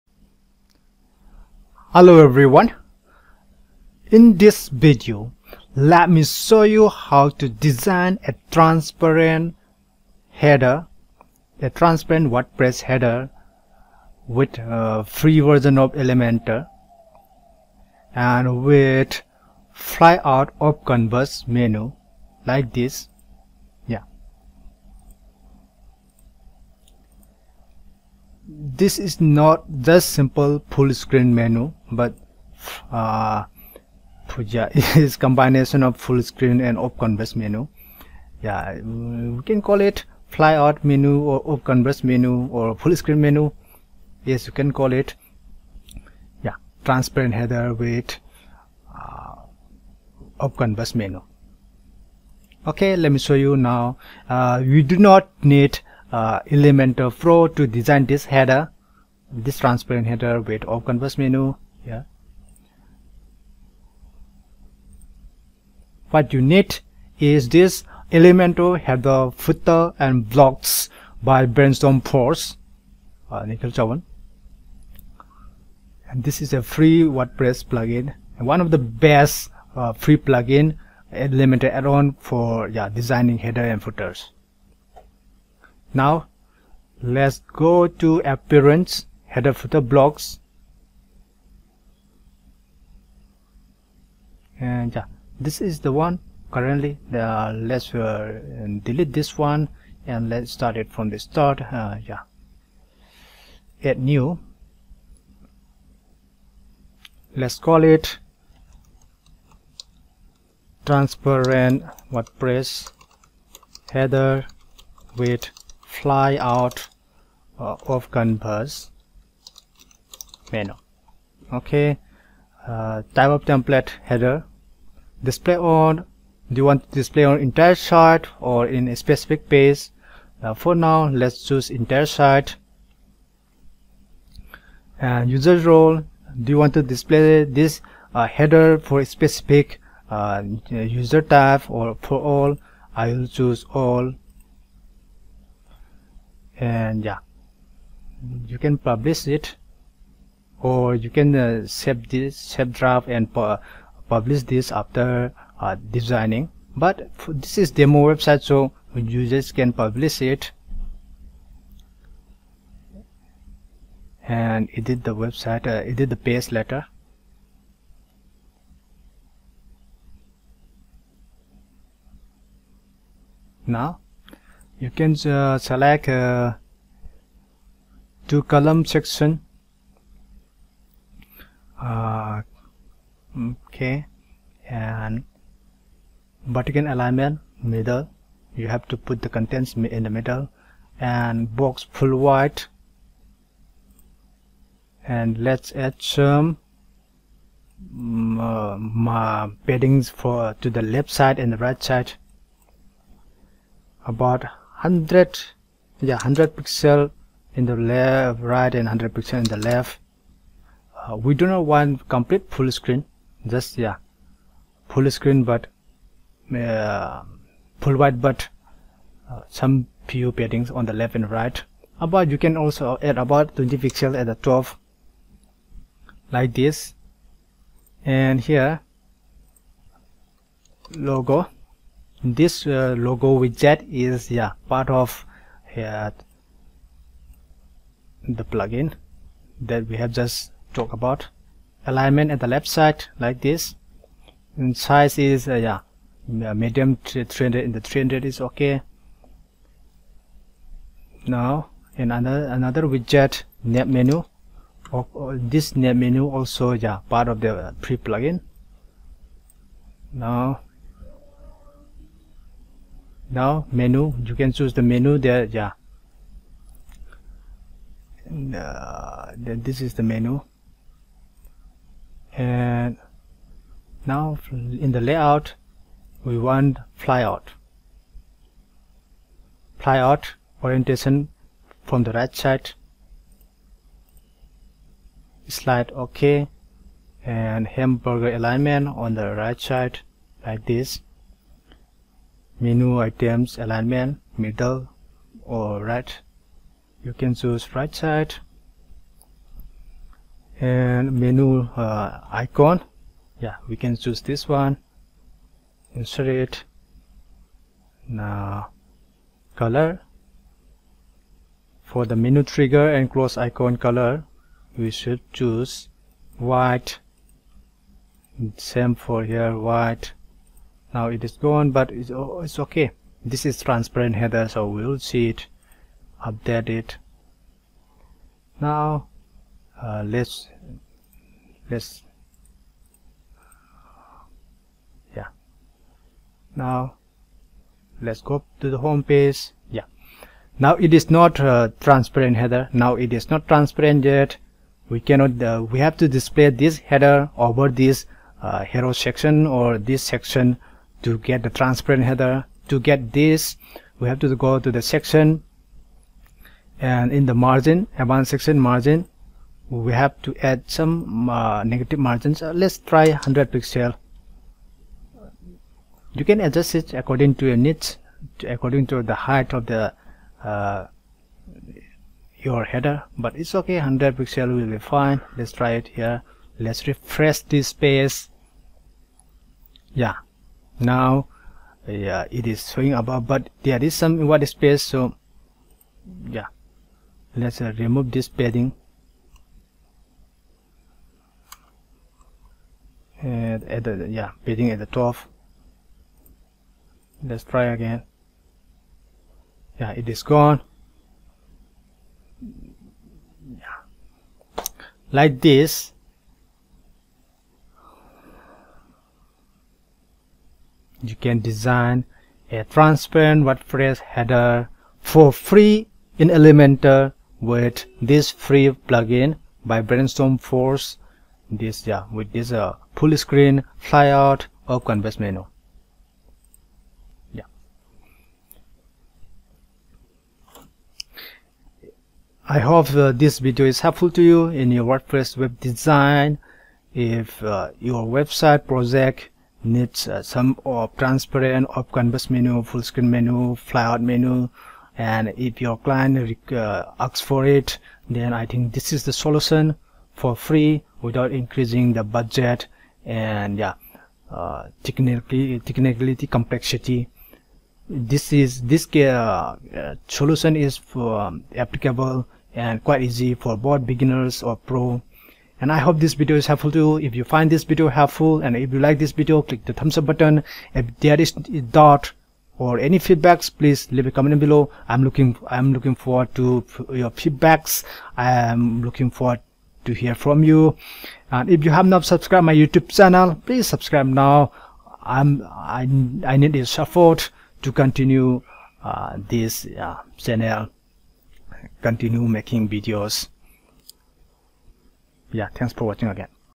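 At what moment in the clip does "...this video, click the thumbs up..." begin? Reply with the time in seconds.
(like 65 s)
468 s.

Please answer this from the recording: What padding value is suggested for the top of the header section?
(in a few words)
20 pixels.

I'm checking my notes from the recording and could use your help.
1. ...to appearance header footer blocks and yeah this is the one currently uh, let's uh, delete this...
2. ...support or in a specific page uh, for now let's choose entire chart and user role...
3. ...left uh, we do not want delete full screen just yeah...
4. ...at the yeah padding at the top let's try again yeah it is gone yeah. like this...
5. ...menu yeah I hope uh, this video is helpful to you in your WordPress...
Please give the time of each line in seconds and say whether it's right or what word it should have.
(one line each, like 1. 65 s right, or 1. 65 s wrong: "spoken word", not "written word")
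1. 87 s right
2. 127 s wrong: "chart", not "support"
3. 209 s wrong: "complete", not "delete"
4. 393 s right
5. 425 s right.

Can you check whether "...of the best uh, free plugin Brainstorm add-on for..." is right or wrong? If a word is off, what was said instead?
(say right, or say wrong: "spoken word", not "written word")
wrong: "Elementor", not "Brainstorm".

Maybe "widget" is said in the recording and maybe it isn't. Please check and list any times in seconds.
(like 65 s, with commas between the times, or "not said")
233 s, 252 s.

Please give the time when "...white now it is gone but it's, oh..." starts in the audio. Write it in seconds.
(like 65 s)
319 s.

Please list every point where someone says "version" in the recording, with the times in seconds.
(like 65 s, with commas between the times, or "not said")
15 s.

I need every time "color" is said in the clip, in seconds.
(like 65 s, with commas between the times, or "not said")
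309 s, 313 s.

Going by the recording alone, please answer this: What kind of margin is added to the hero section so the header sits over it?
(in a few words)
negative margins.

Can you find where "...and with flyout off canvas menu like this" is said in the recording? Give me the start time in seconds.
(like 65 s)
18 s.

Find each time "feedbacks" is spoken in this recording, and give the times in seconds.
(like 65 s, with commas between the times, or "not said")
472 s, 477 s.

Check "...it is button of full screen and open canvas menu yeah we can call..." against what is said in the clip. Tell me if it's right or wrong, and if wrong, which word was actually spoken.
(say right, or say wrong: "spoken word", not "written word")
wrong: "combination", not "button".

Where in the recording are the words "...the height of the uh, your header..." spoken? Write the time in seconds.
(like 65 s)
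369 s.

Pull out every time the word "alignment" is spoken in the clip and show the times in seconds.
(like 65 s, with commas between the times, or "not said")
186 s, 241 s, 288 s, 293 s.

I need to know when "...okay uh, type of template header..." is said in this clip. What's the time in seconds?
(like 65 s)
121 s.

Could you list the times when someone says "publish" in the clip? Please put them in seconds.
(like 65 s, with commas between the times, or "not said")
148 s, 154 s, 159 s.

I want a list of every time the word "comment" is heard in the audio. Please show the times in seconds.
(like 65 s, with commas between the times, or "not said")
474 s.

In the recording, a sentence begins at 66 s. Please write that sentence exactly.
What you need is this Elementor header footer and blocks by Brainstorm Force, uh, Nikhil Chavan.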